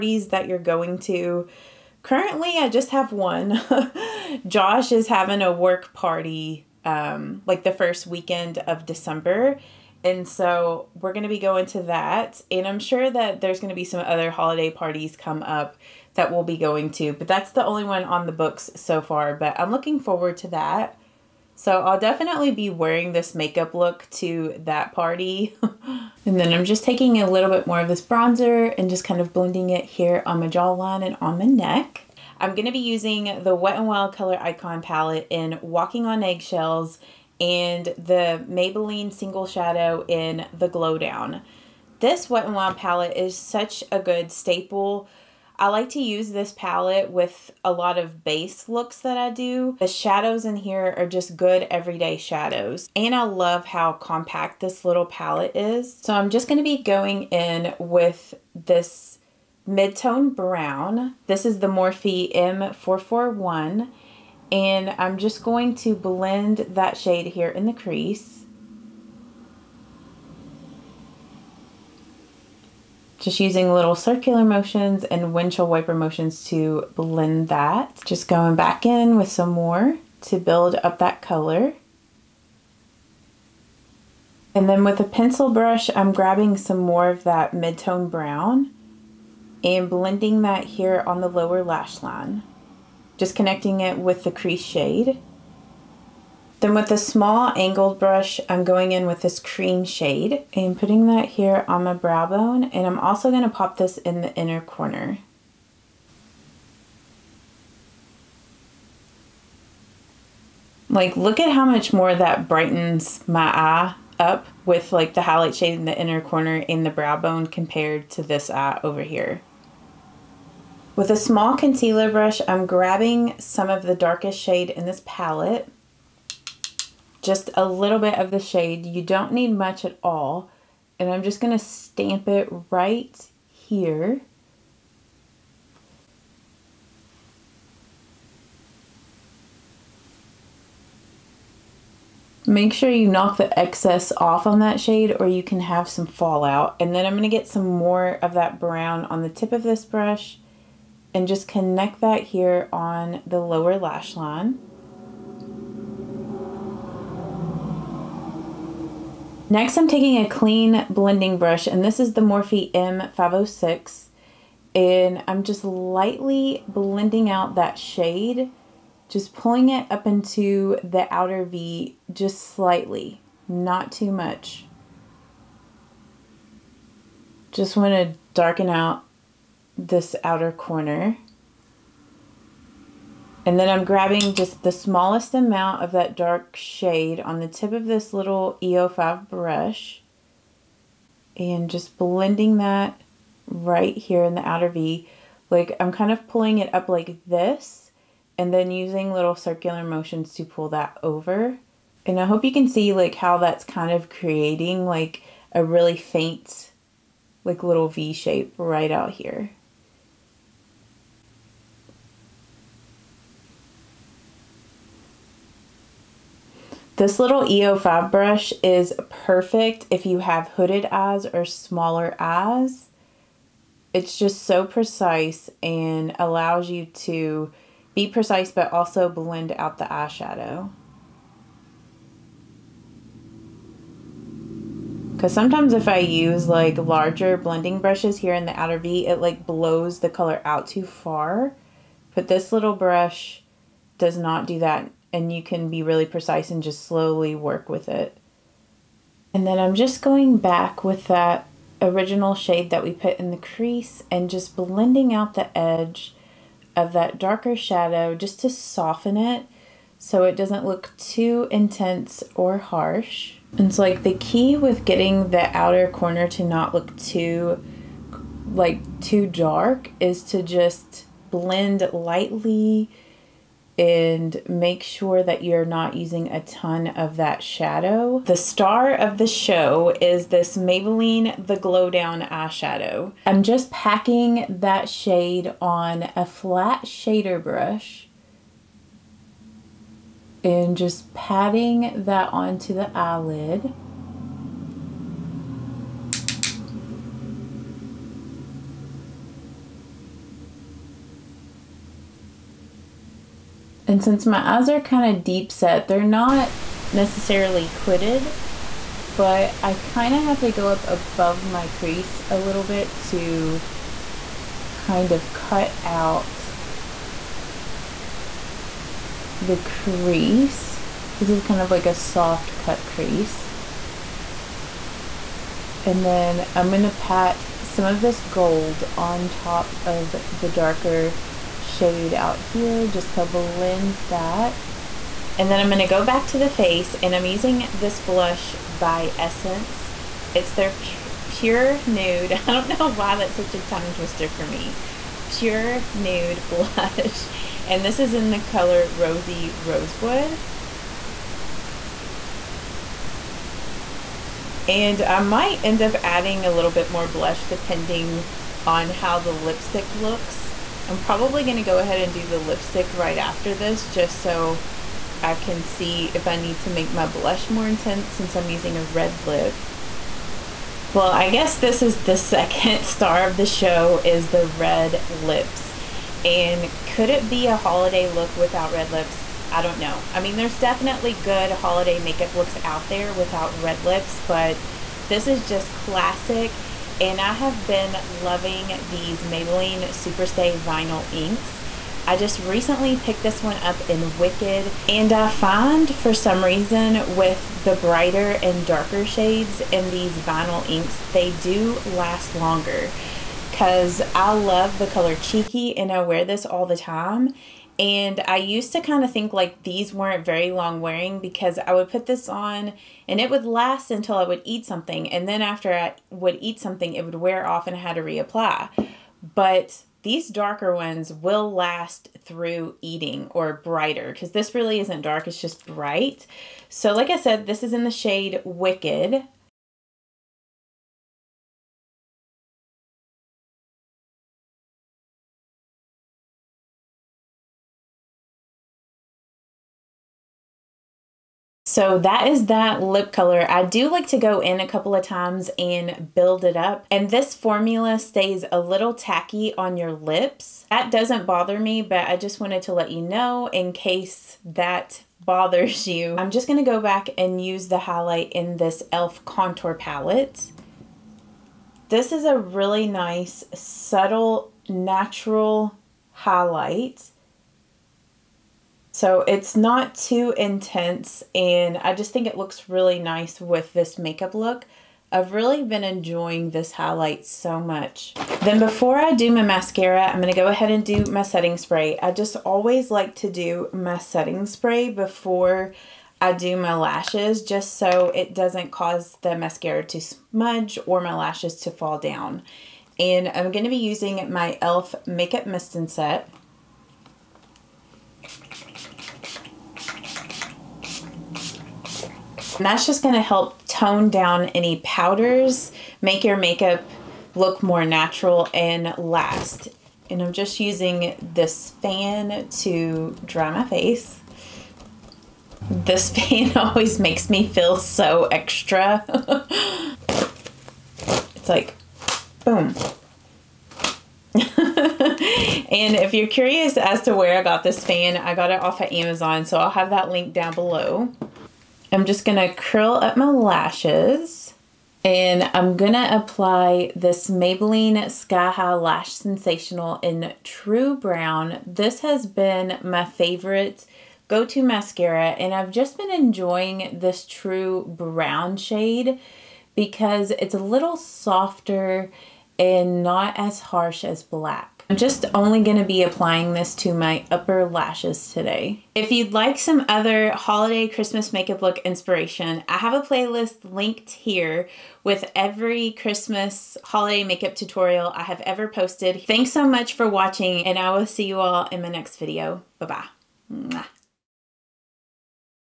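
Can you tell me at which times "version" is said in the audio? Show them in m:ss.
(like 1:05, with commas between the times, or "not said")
not said.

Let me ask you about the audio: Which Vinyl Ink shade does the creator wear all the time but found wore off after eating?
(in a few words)
Cheeky.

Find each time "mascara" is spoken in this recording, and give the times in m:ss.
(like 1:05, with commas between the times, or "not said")
7:59, 8:09, 9:04.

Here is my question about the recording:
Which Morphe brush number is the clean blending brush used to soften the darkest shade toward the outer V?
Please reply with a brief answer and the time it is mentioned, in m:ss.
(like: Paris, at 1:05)
M506, at 2:42.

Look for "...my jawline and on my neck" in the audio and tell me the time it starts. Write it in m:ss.
0:30.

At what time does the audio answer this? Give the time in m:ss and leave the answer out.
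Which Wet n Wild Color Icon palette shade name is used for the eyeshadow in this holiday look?
0:35.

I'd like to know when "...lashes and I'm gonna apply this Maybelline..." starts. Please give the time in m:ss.
8:53.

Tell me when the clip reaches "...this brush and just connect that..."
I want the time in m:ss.
2:29.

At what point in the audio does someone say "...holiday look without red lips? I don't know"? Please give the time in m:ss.
6:17.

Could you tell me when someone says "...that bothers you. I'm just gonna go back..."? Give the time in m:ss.
7:34.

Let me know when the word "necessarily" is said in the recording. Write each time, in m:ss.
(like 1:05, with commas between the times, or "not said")
5:06.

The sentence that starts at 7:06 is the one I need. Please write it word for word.
So, like I said, this is in the shade Wicked.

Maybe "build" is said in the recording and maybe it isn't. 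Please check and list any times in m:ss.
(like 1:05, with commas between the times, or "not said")
1:20, 7:26.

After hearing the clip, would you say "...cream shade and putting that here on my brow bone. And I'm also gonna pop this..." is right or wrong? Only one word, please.
right.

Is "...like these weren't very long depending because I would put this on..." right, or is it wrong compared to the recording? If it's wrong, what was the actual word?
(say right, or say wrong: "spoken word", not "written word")
wrong: "wearing", not "depending".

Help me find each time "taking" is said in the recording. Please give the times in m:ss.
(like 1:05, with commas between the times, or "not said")
0:26, 2:39.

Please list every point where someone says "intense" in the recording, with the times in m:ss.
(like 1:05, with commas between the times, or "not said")
4:21, 6:07, 7:50.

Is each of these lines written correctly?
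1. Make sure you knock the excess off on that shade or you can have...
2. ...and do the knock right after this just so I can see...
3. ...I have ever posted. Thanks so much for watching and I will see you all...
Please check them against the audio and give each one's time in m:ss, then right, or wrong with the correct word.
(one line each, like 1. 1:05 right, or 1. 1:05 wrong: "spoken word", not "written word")
1. 2:22 right
2. 6:01 wrong: "lipstick", not "knock"
3. 9:28 right.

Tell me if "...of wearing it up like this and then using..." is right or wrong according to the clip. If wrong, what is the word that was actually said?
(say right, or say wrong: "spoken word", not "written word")
wrong: "pulling", not "wearing".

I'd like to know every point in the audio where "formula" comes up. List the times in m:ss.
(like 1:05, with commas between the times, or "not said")
7:27.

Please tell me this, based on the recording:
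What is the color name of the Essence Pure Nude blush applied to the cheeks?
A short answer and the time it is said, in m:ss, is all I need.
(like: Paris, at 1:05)
Rosy Rosewood, at 5:48.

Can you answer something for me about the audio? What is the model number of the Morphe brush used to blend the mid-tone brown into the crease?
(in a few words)
M441.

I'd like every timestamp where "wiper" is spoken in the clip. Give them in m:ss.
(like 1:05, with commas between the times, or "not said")
1:15.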